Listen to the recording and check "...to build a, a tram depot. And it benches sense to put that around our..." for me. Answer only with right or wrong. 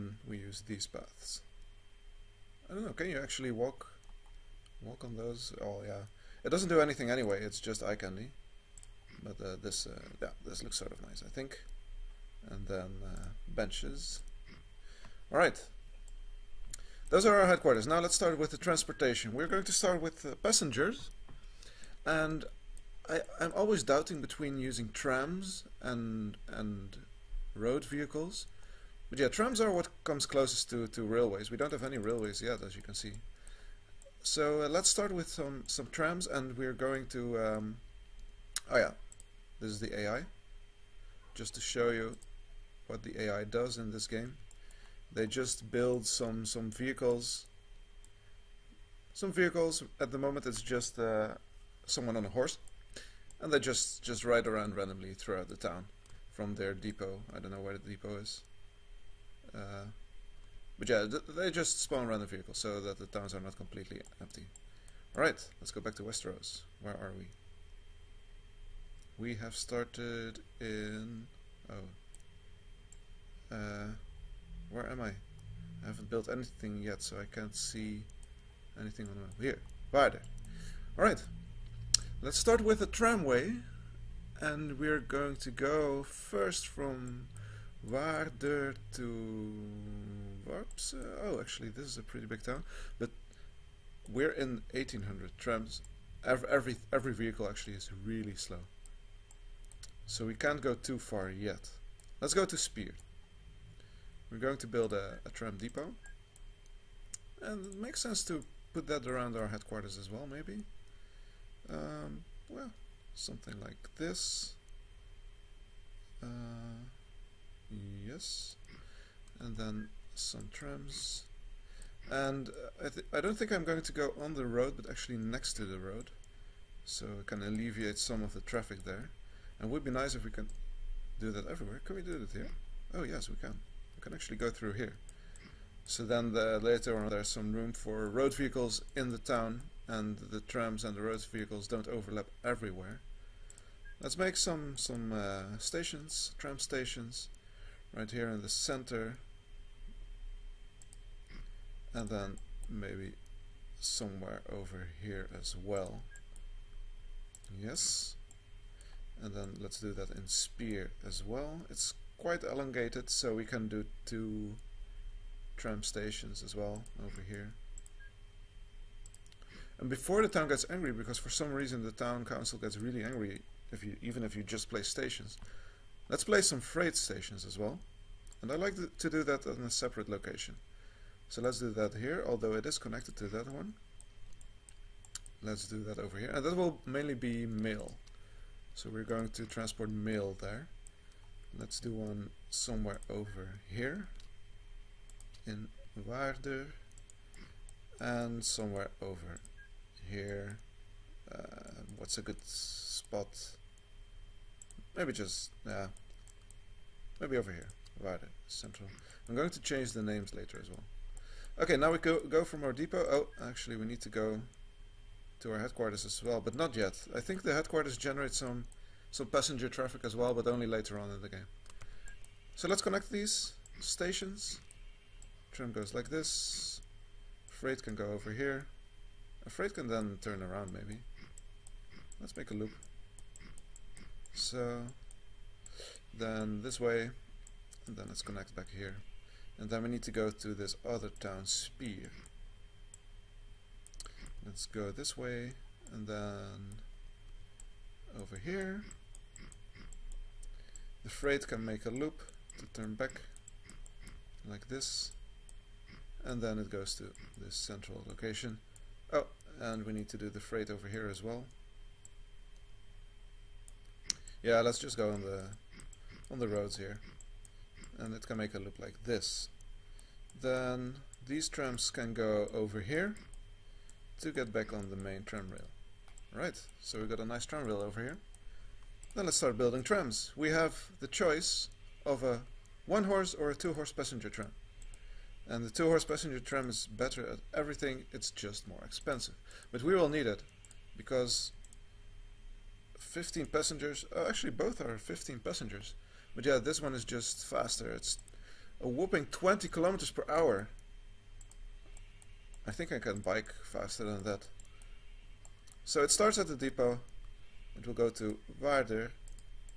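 wrong.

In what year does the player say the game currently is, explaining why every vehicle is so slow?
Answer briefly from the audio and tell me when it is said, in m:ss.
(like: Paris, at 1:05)
1800, at 1:34.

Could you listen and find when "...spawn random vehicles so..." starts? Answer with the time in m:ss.
1:01.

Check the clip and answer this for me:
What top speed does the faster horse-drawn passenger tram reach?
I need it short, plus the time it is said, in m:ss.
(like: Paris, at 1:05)
20 km/h, at 4:59.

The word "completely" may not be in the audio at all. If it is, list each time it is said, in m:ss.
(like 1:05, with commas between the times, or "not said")
1:03.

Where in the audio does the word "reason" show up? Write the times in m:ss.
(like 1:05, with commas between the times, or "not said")
2:51.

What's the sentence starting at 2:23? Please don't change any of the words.
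Let's make some, some uh, stations, tram stations, right here in the center and then maybe somewhere over here as well.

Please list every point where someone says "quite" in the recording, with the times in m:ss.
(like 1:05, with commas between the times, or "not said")
2:42.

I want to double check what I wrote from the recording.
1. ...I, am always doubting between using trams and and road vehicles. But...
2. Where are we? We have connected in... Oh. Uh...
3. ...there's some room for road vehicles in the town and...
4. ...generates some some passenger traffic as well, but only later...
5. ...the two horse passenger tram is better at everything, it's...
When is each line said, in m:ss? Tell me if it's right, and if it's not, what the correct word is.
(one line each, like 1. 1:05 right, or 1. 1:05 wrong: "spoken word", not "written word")
1. 0:23 right
2. 1:06 wrong: "started", not "connected"
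3. 2:17 right
4. 3:37 right
5. 4:45 right.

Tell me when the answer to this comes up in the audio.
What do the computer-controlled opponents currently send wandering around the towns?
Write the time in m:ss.
0:51.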